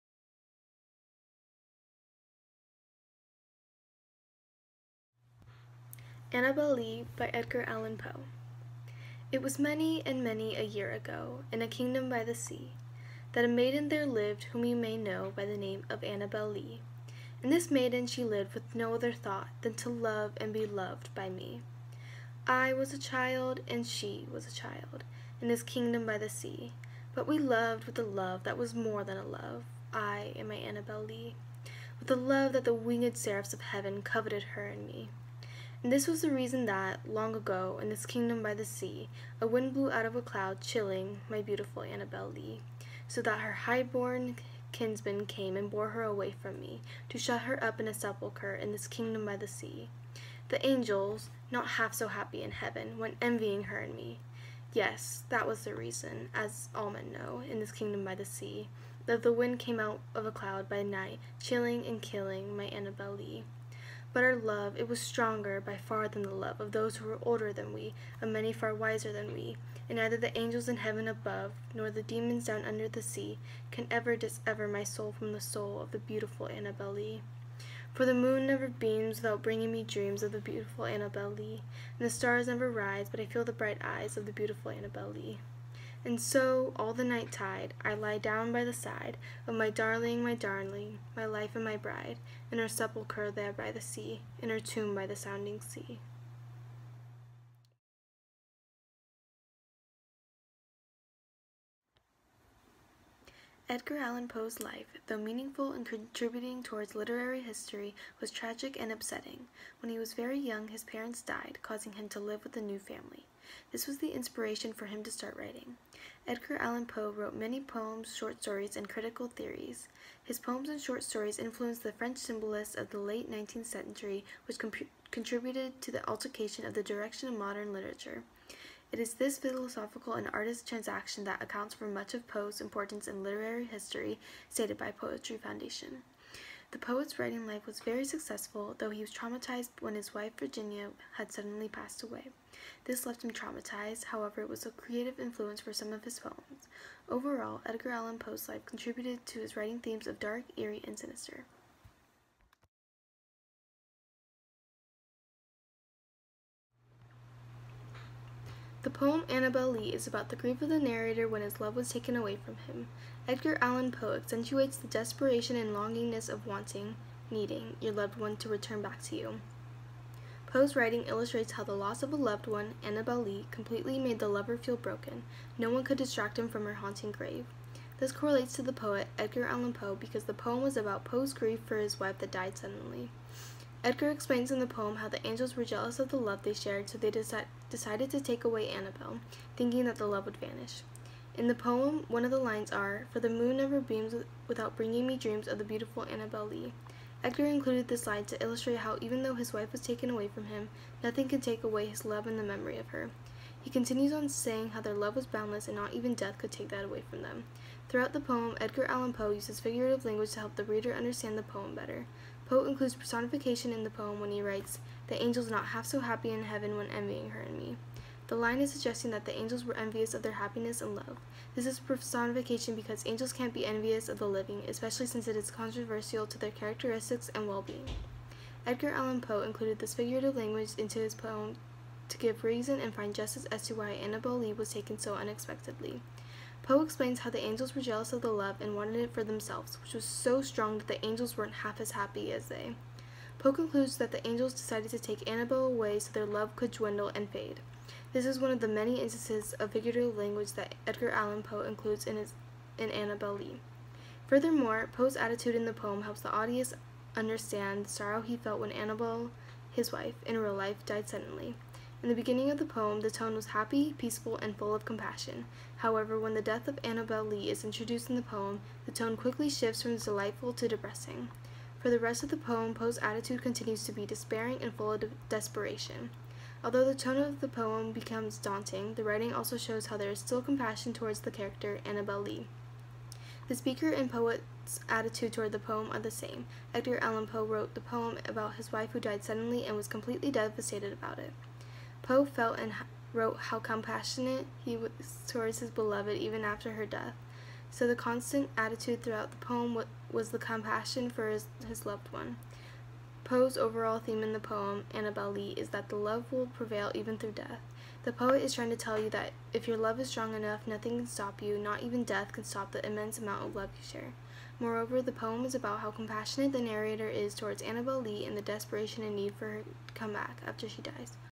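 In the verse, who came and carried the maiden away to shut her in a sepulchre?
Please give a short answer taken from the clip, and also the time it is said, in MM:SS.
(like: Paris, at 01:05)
her high-born kinsman, at 00:43.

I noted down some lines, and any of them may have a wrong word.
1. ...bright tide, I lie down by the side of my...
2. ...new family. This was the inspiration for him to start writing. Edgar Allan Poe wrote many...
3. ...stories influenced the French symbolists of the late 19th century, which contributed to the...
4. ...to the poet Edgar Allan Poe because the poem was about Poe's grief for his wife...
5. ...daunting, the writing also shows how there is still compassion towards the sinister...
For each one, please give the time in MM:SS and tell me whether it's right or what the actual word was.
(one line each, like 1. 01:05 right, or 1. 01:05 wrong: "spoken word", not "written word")
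1. 01:27 wrong: "night", not "bright"
2. 01:52 right
3. 02:01 right
4. 02:58 right
5. 04:38 wrong: "character", not "sinister".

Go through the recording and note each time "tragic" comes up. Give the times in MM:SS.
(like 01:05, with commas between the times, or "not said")
01:48.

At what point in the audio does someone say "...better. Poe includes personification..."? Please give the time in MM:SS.
03:31.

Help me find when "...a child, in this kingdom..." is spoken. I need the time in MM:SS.
00:24.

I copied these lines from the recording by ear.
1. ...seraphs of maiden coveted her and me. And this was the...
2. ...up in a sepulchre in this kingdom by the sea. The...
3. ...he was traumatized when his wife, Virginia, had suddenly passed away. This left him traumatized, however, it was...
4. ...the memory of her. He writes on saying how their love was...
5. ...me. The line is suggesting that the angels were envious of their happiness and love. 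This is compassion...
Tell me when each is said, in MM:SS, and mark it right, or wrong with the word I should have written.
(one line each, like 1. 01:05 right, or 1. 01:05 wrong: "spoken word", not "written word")
1. 00:33 wrong: "heaven", not "maiden"
2. 00:47 right
3. 02:18 right
4. 03:22 wrong: "continues", not "writes"
5. 03:37 wrong: "personification", not "compassion".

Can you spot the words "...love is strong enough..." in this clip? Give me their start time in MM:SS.
05:09.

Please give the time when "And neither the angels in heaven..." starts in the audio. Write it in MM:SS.
01:09.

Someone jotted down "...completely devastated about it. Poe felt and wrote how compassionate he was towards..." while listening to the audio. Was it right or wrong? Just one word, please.
right.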